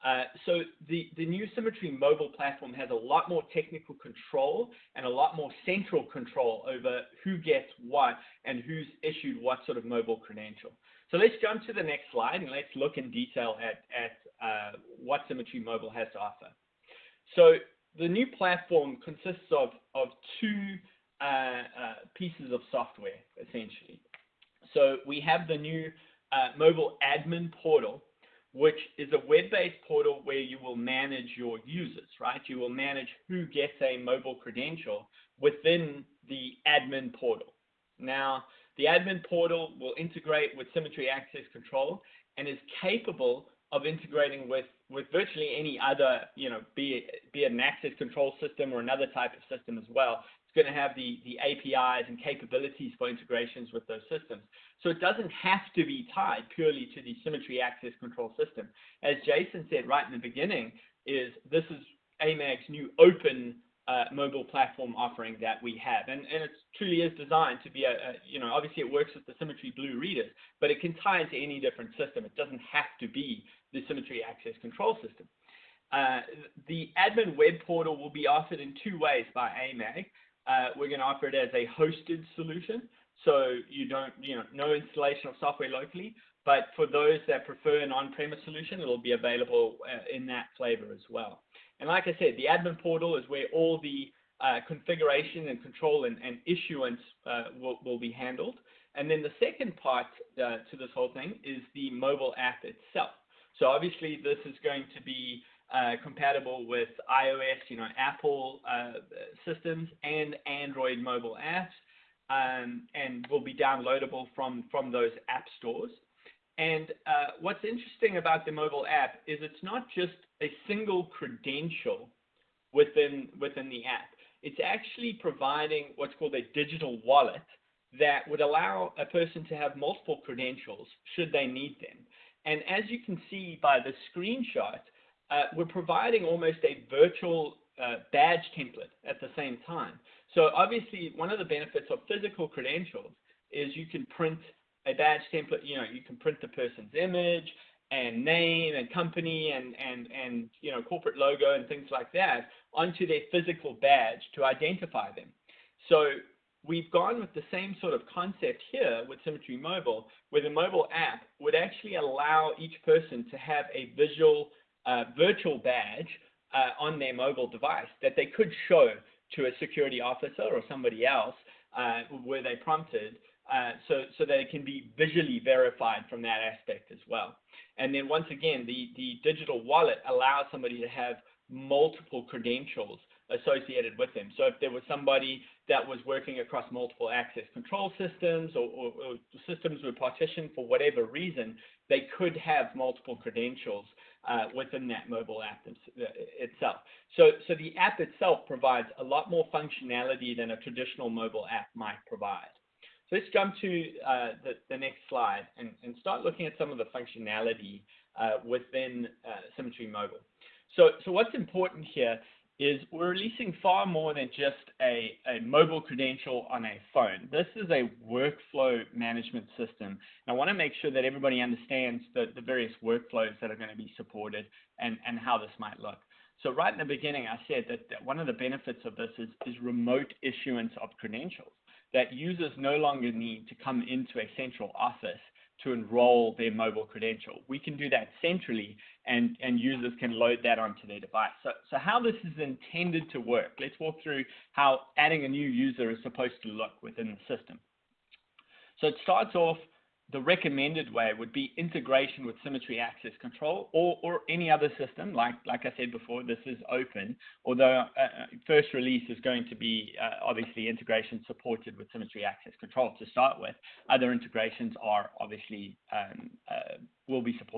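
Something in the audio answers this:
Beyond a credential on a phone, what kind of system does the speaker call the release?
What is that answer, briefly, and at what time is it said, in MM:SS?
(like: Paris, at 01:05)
Workflow management system, at 03:38.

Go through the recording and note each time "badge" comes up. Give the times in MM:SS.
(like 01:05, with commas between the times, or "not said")
02:18, 02:24, 02:33, 02:45.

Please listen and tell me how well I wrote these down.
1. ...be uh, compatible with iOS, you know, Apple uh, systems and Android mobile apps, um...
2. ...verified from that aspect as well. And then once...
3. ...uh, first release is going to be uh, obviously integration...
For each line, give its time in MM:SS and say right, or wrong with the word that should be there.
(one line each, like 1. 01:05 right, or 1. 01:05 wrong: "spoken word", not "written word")
1. 01:45 right
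2. 02:55 right
3. 04:18 right.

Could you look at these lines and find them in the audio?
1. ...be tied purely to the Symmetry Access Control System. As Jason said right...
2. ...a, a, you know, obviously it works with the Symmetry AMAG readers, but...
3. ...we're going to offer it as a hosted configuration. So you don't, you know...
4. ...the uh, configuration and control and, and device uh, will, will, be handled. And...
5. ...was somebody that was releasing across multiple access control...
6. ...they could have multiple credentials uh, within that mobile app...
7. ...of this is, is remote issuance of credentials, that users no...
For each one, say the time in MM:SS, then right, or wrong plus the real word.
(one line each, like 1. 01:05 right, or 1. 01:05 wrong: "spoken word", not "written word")
1. 00:55 right
2. 01:07 wrong: "Blue", not "AMAG"
3. 01:20 wrong: "solution", not "configuration"
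4. 01:33 wrong: "issuance", not "device"
5. 03:04 wrong: "working", not "releasing"
6. 03:11 right
7. 03:48 right.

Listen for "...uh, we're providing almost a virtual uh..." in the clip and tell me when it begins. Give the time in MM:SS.
02:15.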